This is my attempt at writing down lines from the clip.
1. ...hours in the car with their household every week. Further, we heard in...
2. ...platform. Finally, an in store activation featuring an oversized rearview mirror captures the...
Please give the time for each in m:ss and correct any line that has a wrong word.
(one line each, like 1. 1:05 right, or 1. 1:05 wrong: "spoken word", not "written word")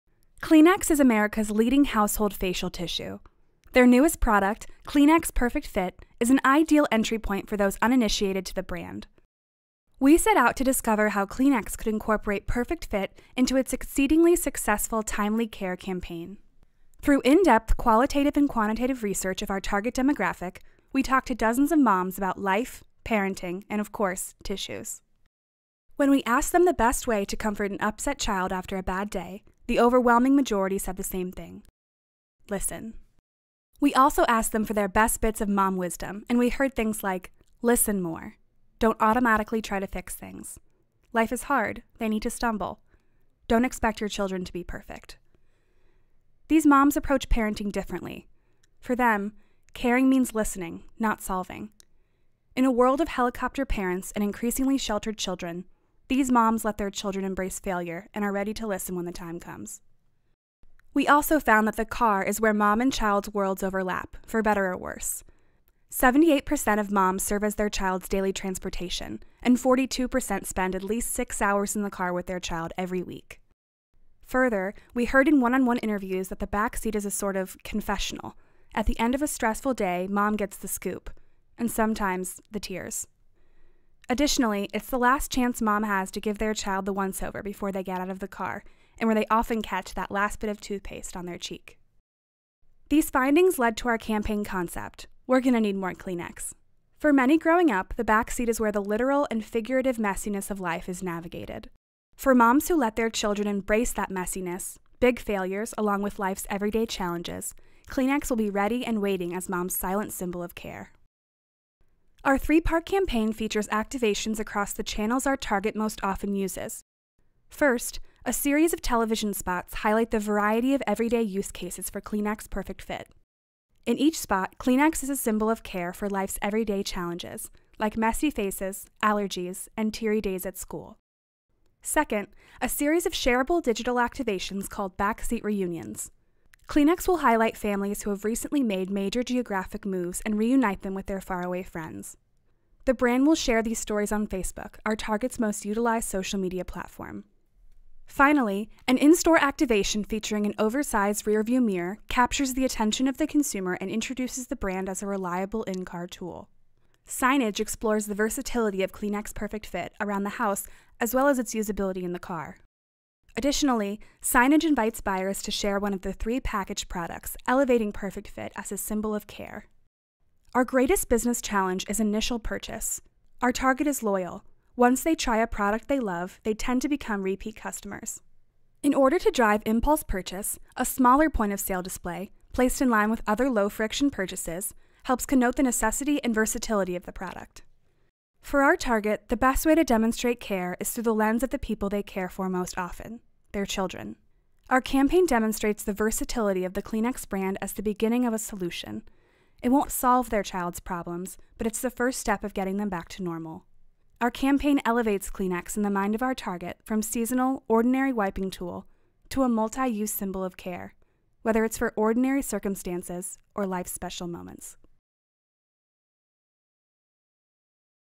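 1. 1:11 wrong: "child", not "household"
2. 2:26 right.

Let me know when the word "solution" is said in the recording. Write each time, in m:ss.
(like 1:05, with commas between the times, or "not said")
3:18.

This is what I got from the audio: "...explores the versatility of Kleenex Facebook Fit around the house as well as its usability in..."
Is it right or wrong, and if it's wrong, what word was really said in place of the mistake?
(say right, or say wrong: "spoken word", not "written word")
wrong: "Perfect", not "Facebook".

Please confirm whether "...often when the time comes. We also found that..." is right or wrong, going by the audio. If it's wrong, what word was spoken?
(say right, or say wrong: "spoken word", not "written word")
wrong: "listen", not "often".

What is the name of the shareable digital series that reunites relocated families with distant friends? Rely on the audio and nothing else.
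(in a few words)
backseat reunions.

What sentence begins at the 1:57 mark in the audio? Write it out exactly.
First, a series of television spots highlight the variety of everyday use cases for Kleenex Perfect Fit.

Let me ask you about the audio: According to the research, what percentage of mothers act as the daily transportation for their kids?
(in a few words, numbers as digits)
78%.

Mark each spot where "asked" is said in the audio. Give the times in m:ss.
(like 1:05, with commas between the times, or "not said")
0:26, 0:34.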